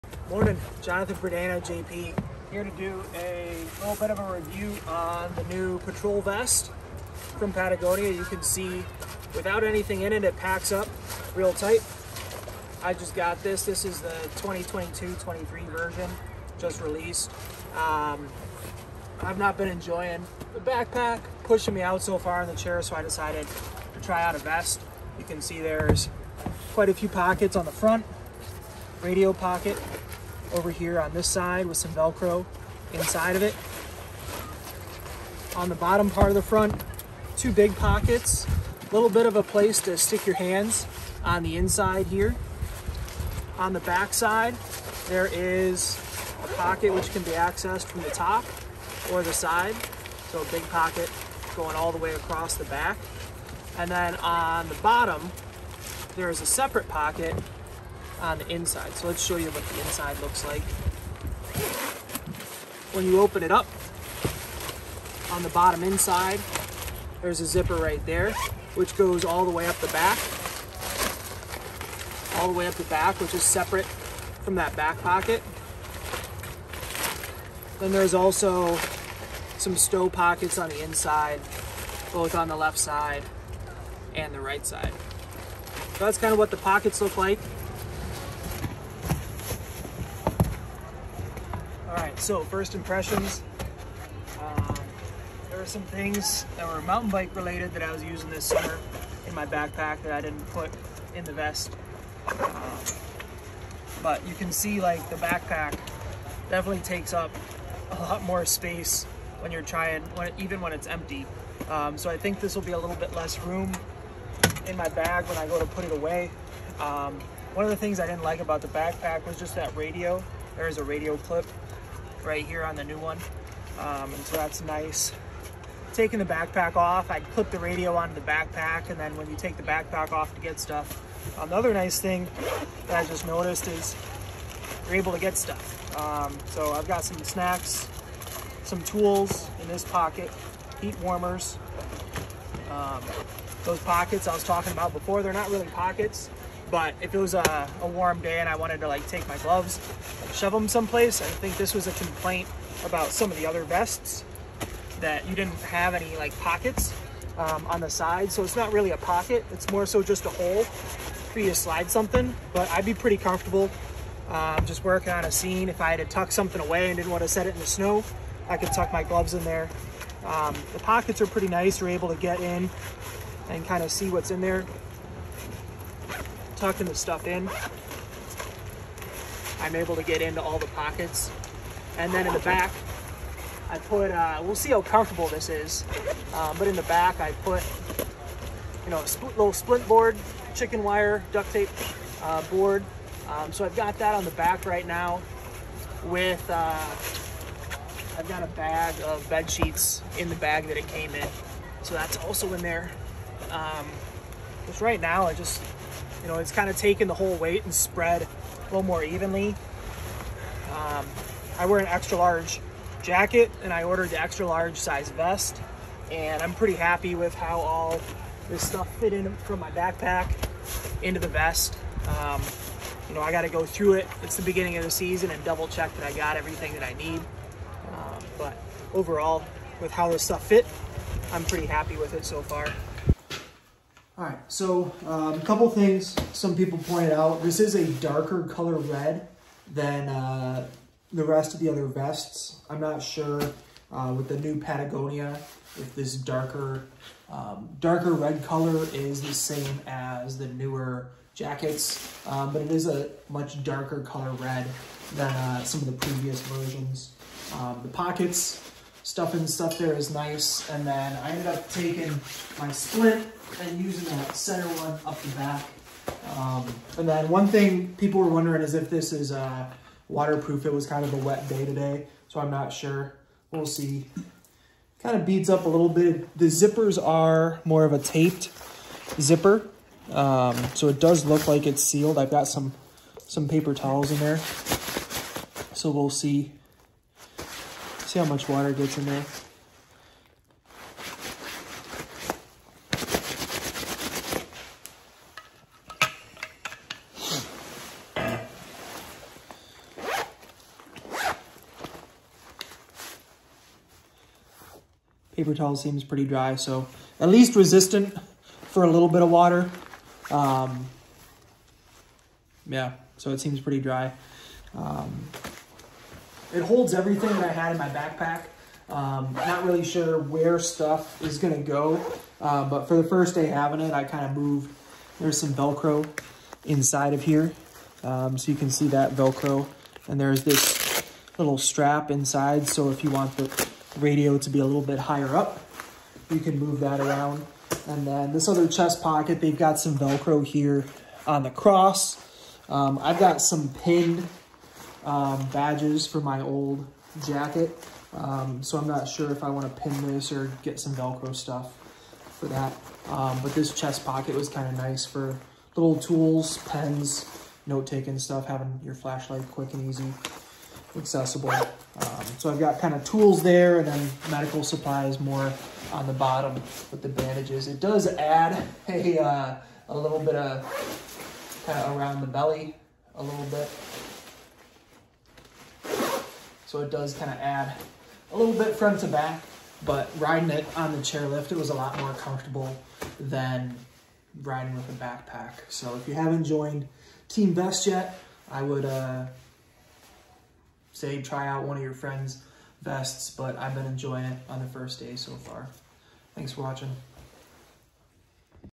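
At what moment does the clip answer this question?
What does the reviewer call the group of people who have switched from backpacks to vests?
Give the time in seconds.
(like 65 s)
387 s.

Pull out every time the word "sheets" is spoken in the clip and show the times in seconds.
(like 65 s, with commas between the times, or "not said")
199 s.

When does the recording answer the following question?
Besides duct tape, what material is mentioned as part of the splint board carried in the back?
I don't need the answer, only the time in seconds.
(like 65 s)
190 s.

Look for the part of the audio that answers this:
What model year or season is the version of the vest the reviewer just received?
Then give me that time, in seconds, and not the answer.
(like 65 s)
14 s.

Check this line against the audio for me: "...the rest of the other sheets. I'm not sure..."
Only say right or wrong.
wrong.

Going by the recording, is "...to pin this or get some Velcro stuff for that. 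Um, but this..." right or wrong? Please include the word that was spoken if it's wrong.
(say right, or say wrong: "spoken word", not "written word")
right.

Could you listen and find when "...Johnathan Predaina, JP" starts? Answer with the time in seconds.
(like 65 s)
0 s.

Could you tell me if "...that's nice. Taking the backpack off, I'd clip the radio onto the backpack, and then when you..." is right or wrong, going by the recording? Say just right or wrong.
right.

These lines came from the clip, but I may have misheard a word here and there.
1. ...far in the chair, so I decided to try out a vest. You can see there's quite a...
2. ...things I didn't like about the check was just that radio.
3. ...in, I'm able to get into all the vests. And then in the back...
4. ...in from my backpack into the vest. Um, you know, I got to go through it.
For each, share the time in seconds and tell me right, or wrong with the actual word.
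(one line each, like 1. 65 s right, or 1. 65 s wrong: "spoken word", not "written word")
1. 22 s right
2. 117 s wrong: "backpack", not "check"
3. 177 s wrong: "pockets", not "vests"
4. 219 s right.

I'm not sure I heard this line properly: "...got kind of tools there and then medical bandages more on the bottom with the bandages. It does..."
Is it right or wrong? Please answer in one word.
wrong.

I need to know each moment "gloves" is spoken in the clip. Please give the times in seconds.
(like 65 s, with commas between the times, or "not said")
149 s, 169 s.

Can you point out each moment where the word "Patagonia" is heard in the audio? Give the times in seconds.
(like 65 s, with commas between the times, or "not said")
7 s, 244 s.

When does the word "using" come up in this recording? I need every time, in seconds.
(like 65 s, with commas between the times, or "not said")
98 s, 263 s.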